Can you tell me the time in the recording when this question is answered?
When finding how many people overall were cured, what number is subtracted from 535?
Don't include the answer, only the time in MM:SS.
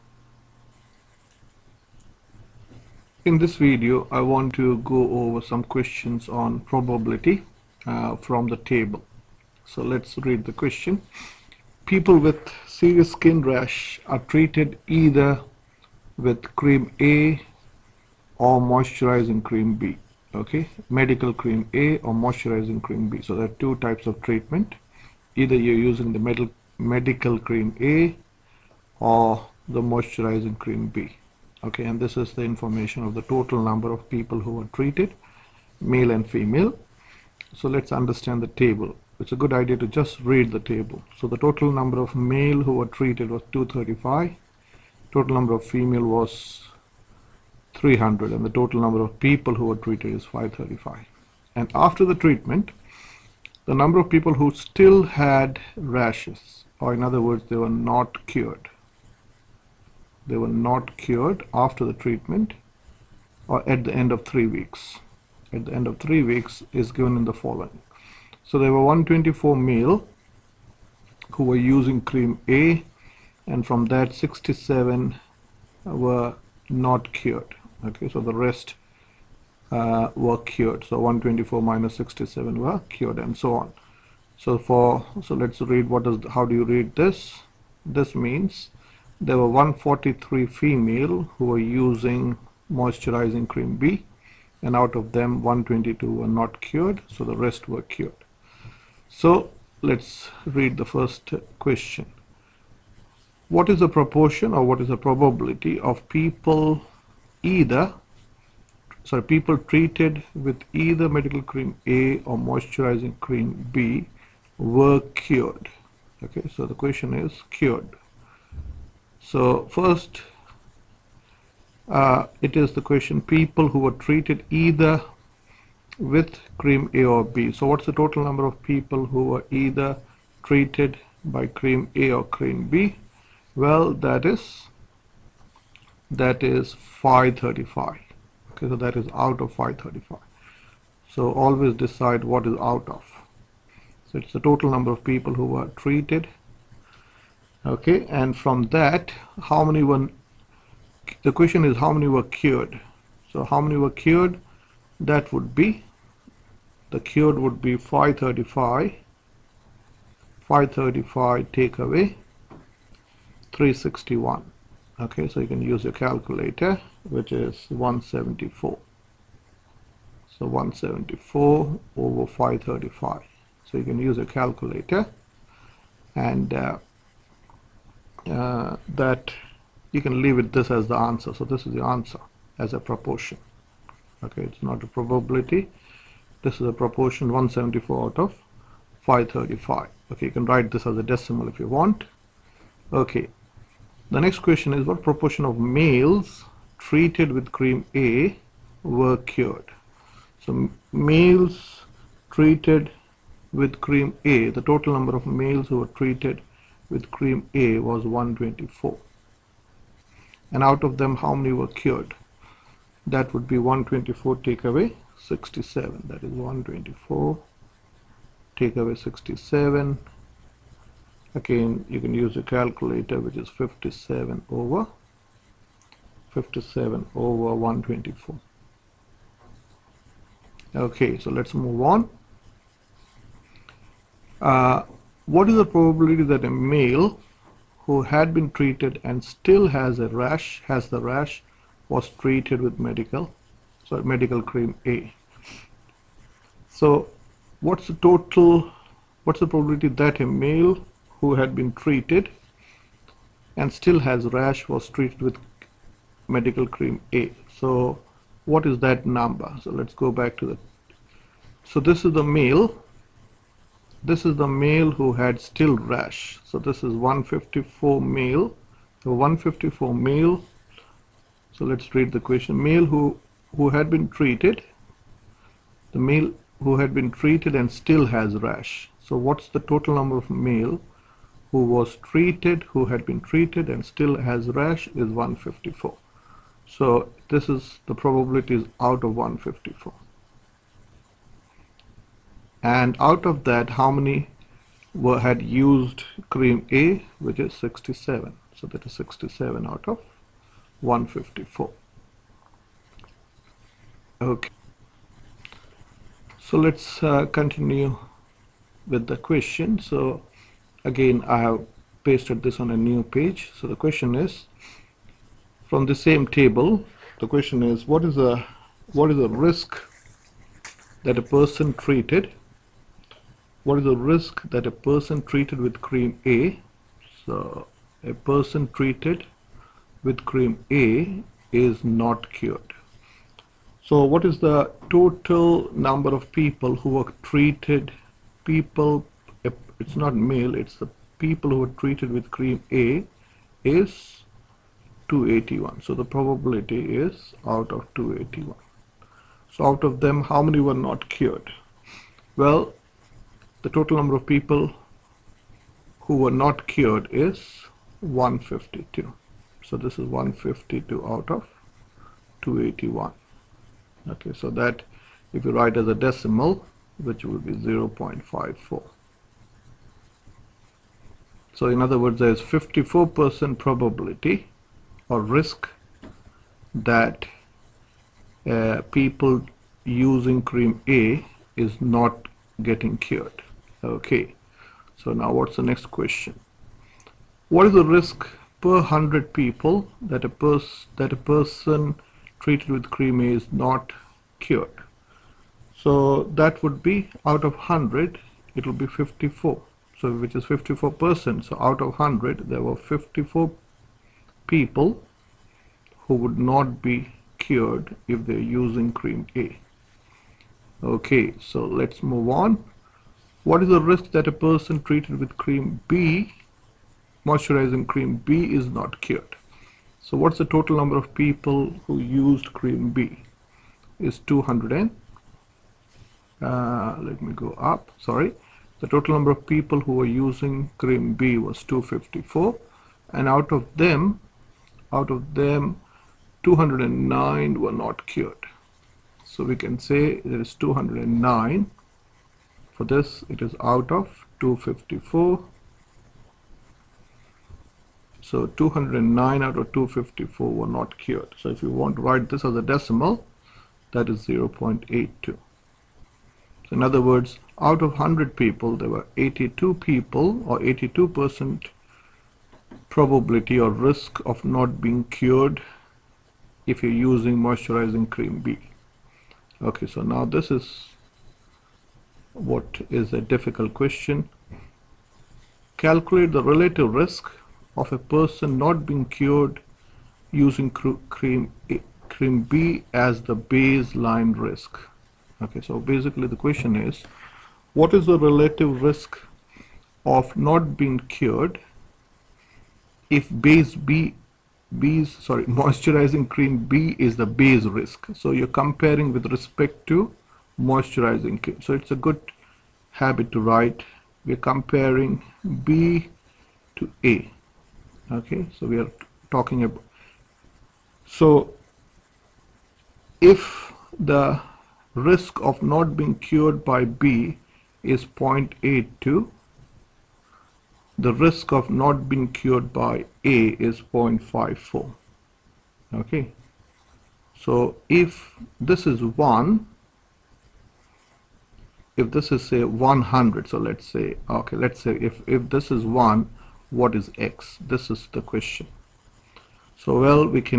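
02:43.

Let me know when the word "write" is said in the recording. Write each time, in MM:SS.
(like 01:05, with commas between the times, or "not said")
03:10, 06:05, 07:32, 08:23.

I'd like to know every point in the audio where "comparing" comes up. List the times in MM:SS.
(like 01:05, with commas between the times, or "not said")
08:18, 08:24.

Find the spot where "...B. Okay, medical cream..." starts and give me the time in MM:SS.
00:19.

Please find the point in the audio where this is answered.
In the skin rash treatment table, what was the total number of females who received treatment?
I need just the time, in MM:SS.
00:47.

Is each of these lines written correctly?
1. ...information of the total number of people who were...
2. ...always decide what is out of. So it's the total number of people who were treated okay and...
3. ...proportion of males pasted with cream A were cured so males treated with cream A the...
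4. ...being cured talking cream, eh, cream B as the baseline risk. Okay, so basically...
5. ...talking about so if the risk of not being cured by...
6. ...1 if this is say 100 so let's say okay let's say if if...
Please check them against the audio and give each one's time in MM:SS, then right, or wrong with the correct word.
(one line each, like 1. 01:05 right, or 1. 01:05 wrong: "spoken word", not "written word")
1. 00:32 right
2. 02:21 right
3. 03:15 wrong: "treated", not "pasted"
4. 07:58 wrong: "using", not "talking"
5. 08:29 right
6. 08:49 right.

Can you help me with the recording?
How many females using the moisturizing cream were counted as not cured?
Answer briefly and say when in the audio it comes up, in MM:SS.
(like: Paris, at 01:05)
122, at 01:35.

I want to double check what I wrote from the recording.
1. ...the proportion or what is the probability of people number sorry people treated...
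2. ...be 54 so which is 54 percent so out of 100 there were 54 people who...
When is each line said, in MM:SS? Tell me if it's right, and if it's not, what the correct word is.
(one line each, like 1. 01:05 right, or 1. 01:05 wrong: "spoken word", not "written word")
1. 01:43 wrong: "either", not "number"
2. 06:38 right.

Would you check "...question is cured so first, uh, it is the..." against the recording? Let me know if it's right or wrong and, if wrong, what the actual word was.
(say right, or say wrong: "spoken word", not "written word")
right.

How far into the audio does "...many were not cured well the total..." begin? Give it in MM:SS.
05:50.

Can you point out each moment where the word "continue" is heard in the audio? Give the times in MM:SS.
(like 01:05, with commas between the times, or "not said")
05:07.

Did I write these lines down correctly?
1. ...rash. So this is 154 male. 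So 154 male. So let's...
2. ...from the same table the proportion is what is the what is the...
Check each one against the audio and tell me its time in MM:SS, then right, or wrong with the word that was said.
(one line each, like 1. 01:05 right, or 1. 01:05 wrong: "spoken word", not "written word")
1. 04:25 right
2. 05:15 wrong: "question", not "proportion".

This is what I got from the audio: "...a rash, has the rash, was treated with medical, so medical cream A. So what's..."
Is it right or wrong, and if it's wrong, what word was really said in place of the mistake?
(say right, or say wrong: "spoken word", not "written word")
right.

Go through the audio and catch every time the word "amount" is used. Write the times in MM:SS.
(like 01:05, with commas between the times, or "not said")
not said.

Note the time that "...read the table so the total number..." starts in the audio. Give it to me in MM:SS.
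00:40.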